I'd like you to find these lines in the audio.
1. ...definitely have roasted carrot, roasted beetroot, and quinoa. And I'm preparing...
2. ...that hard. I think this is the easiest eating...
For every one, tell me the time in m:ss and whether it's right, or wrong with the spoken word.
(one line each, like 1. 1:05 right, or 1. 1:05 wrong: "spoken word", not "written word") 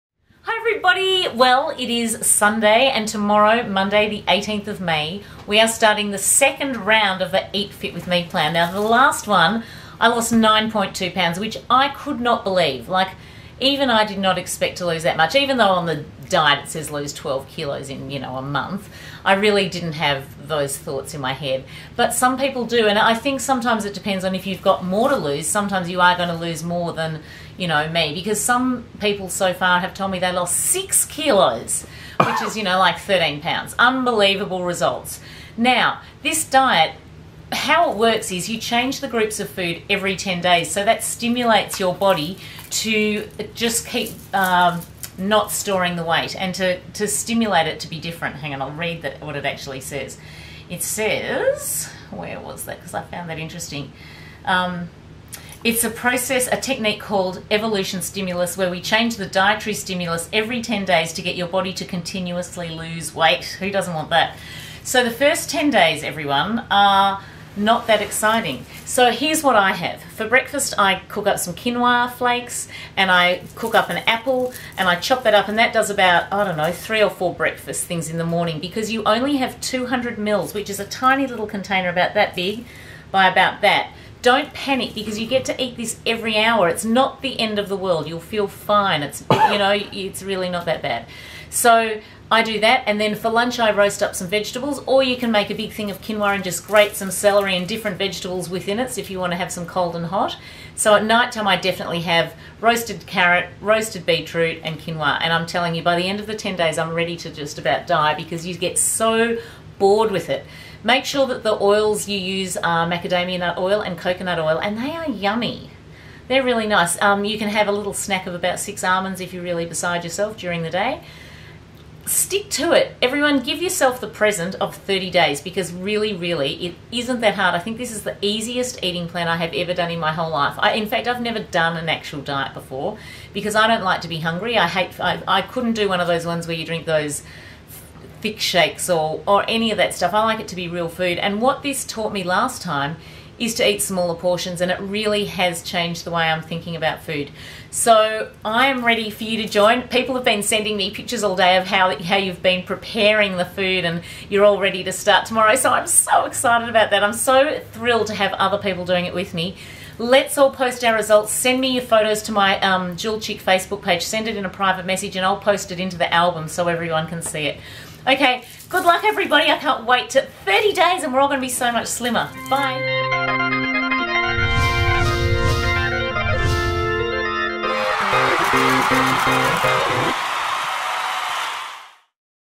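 1. 1:41 wrong: "telling", not "preparing"
2. 2:07 right.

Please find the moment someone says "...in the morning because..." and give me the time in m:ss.
1:18.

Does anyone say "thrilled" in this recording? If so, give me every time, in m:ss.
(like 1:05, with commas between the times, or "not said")
2:37.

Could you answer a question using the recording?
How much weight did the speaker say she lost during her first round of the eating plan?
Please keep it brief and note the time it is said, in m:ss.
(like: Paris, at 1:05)
9.2 pounds, at 0:10.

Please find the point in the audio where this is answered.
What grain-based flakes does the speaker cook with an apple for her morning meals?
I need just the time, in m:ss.
1:11.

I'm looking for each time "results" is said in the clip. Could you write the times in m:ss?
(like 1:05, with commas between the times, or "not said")
0:34, 2:40.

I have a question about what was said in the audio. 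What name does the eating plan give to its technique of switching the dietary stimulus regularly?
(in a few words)
evolution stimulus.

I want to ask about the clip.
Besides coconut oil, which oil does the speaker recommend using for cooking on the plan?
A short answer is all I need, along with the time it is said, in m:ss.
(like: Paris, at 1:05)
macadamia nut oil, at 1:52.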